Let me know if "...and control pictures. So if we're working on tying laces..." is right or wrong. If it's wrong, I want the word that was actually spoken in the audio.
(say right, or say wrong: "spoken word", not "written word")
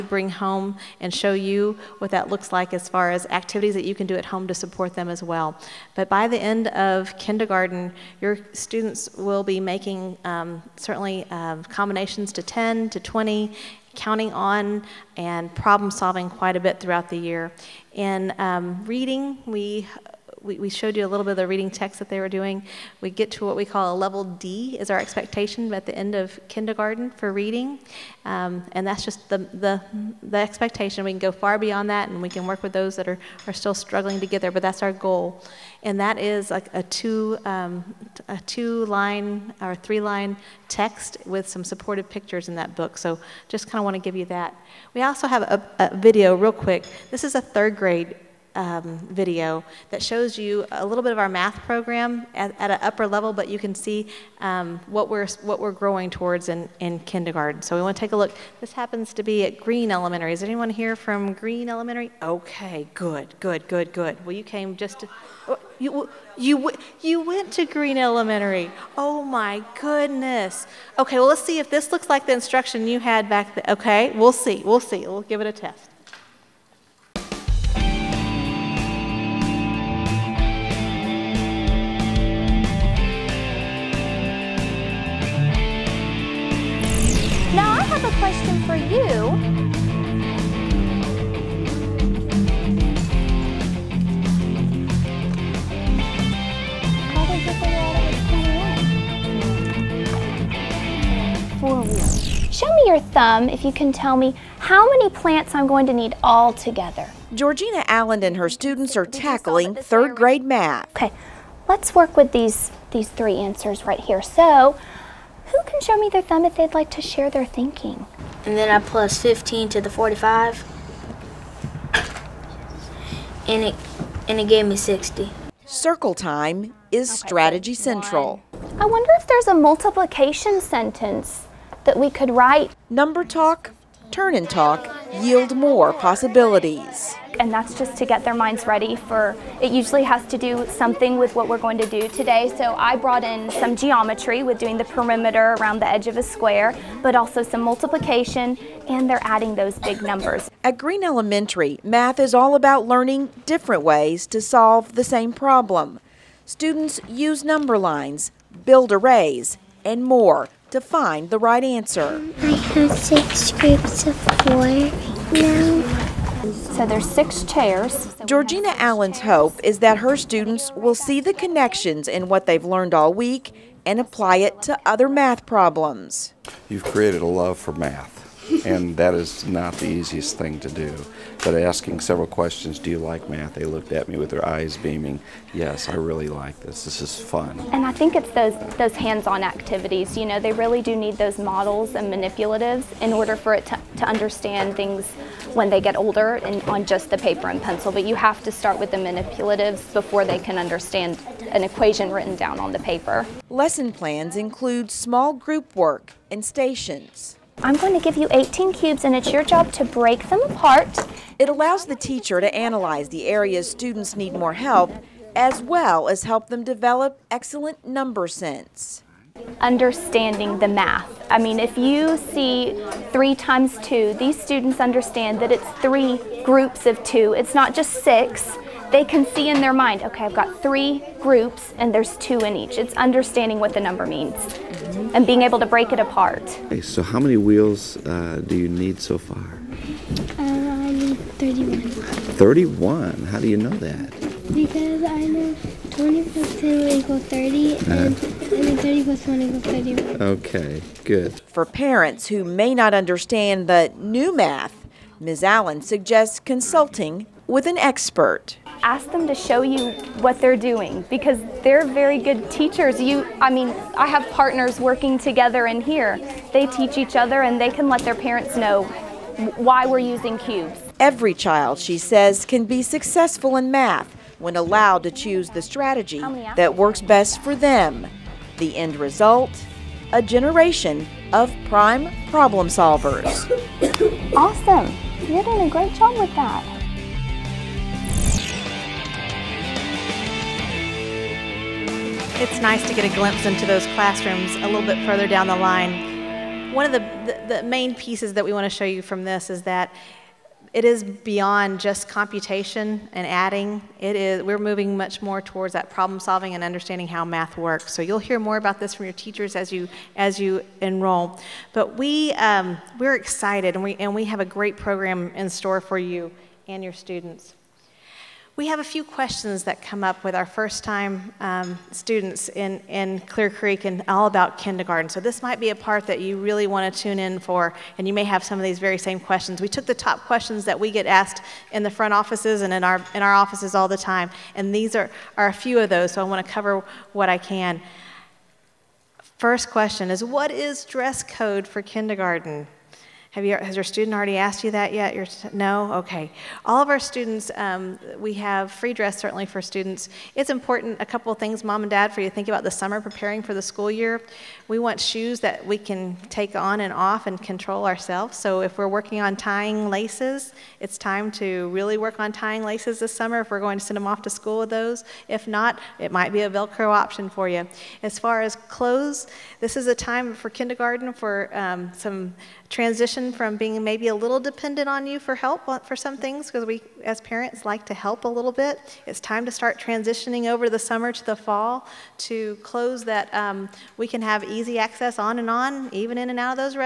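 wrong: "ourselves", not "pictures".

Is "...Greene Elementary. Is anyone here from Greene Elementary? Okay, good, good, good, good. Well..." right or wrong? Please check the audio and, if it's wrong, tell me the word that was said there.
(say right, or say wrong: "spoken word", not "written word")
right.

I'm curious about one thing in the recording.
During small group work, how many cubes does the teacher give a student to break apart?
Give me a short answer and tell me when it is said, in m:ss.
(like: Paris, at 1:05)
18, at 3:28.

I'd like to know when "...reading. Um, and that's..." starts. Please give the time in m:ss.
0:27.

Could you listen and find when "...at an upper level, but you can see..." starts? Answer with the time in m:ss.
0:52.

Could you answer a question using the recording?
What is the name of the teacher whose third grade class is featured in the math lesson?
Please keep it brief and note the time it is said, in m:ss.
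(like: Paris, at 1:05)
Georgina Allen, at 1:47.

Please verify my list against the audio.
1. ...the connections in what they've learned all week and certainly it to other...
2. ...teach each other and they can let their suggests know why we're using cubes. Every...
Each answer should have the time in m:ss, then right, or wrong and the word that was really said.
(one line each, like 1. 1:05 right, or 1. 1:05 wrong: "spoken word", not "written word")
1. 2:51 wrong: "apply", not "certainly"
2. 4:26 wrong: "parents", not "suggests".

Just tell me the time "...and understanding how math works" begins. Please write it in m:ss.
5:06.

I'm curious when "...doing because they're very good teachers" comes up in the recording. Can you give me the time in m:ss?
4:20.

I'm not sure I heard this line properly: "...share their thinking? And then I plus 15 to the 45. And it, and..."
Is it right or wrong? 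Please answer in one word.
right.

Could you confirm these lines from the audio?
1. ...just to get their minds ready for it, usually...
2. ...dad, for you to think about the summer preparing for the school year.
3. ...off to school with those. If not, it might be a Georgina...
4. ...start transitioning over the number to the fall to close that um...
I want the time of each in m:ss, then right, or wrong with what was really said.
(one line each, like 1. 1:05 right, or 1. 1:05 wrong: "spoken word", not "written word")
1. 2:17 right
2. 5:51 right
3. 6:04 wrong: "Velcro", not "Georgina"
4. 6:19 wrong: "summer", not "number".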